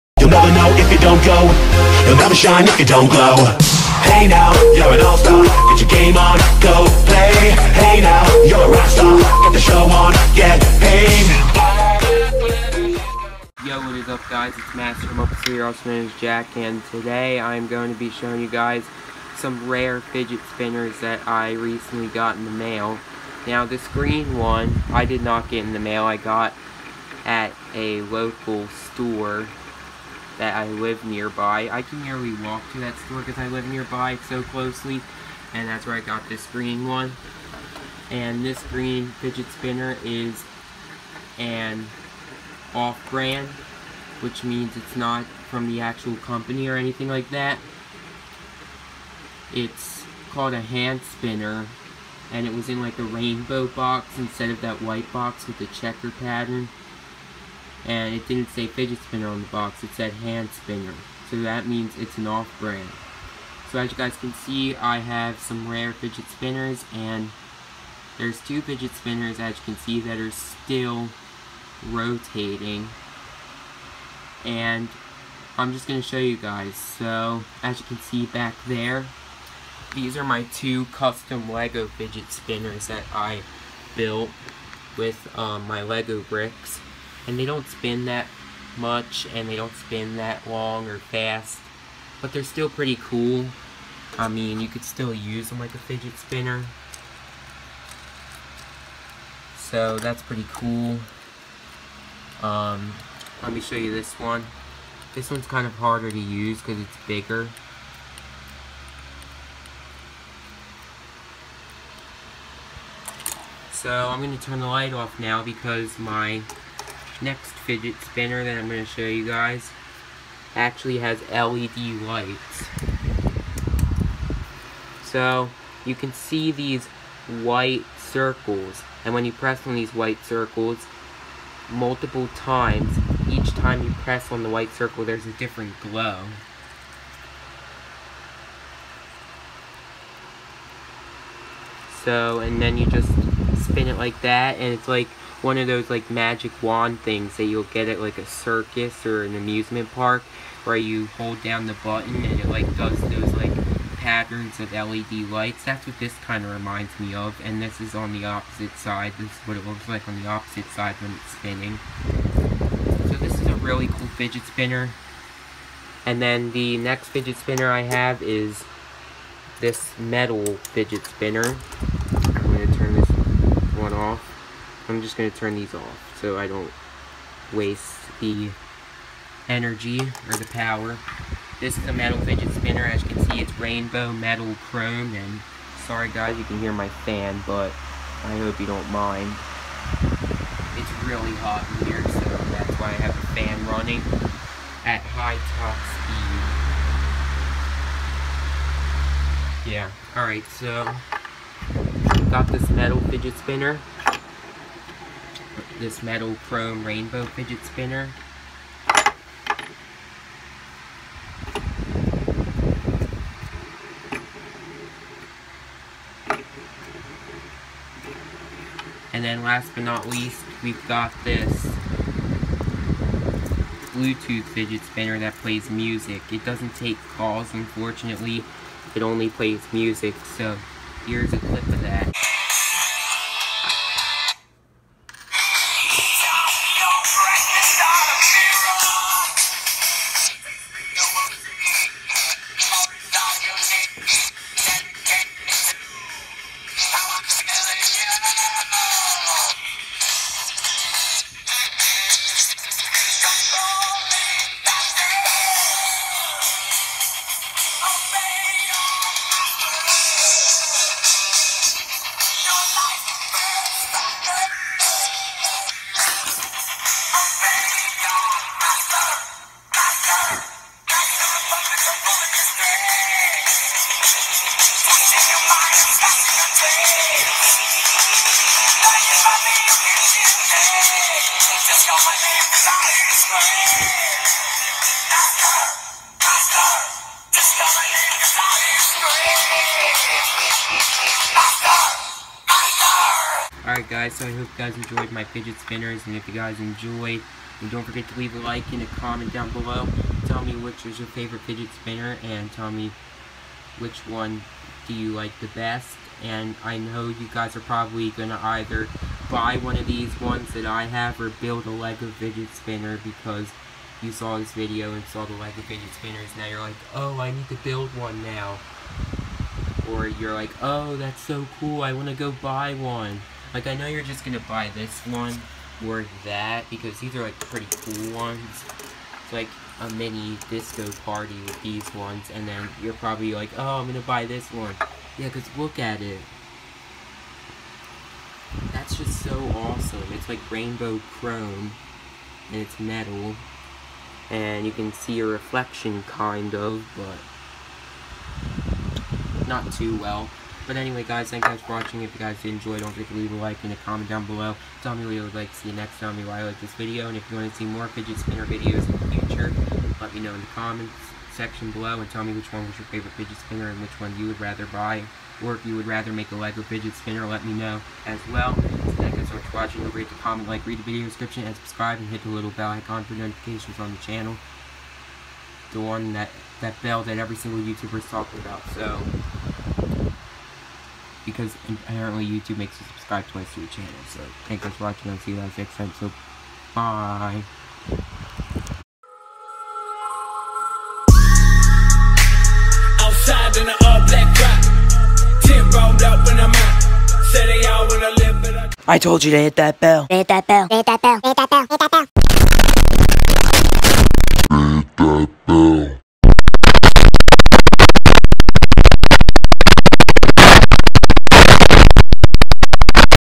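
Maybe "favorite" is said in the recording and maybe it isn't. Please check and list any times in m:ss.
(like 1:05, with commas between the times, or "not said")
5:01, 6:02.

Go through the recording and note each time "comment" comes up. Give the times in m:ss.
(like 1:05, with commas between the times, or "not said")
4:58, 5:53, 6:00, 6:10.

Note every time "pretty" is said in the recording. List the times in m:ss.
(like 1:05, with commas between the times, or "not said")
1:32, 1:40, 5:27.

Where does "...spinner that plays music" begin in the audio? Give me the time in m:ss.
3:44.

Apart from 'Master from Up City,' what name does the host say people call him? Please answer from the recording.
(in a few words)
Jack.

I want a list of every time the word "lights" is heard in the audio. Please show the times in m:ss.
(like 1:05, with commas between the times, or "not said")
1:54, 2:02, 2:35.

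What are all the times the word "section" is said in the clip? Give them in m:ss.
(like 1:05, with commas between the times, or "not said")
6:01.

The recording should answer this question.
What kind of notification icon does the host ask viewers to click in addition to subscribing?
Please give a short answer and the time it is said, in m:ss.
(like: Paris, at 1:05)
bell icon, at 6:12.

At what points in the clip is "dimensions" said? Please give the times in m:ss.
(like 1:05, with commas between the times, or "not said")
not said.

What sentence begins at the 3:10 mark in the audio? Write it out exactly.
It's really hot in here, so that's why I have a fan running at high top speed.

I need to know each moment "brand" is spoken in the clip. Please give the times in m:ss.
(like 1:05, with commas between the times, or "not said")
0:42, 1:02.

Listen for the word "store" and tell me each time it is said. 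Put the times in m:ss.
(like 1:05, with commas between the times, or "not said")
0:28, 0:33.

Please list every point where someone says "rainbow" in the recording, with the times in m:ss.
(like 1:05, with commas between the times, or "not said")
0:53, 3:03, 3:26, 5:40.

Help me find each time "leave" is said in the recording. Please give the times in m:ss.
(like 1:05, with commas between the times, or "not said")
4:58, 5:53.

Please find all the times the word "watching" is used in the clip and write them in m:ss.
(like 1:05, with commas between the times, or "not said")
5:51, 6:09, 6:24.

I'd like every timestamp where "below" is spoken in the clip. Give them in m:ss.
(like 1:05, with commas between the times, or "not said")
4:59, 5:54, 6:01.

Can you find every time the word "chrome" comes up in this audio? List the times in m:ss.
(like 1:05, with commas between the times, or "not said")
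3:04, 3:26, 5:41.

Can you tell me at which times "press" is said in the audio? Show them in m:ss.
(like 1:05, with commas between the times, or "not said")
2:09, 2:13.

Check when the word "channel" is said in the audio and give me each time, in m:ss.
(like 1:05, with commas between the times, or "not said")
6:13, 6:23.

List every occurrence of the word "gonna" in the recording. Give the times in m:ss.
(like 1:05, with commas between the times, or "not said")
5:24, 5:33.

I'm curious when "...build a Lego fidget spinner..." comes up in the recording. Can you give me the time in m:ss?
5:11.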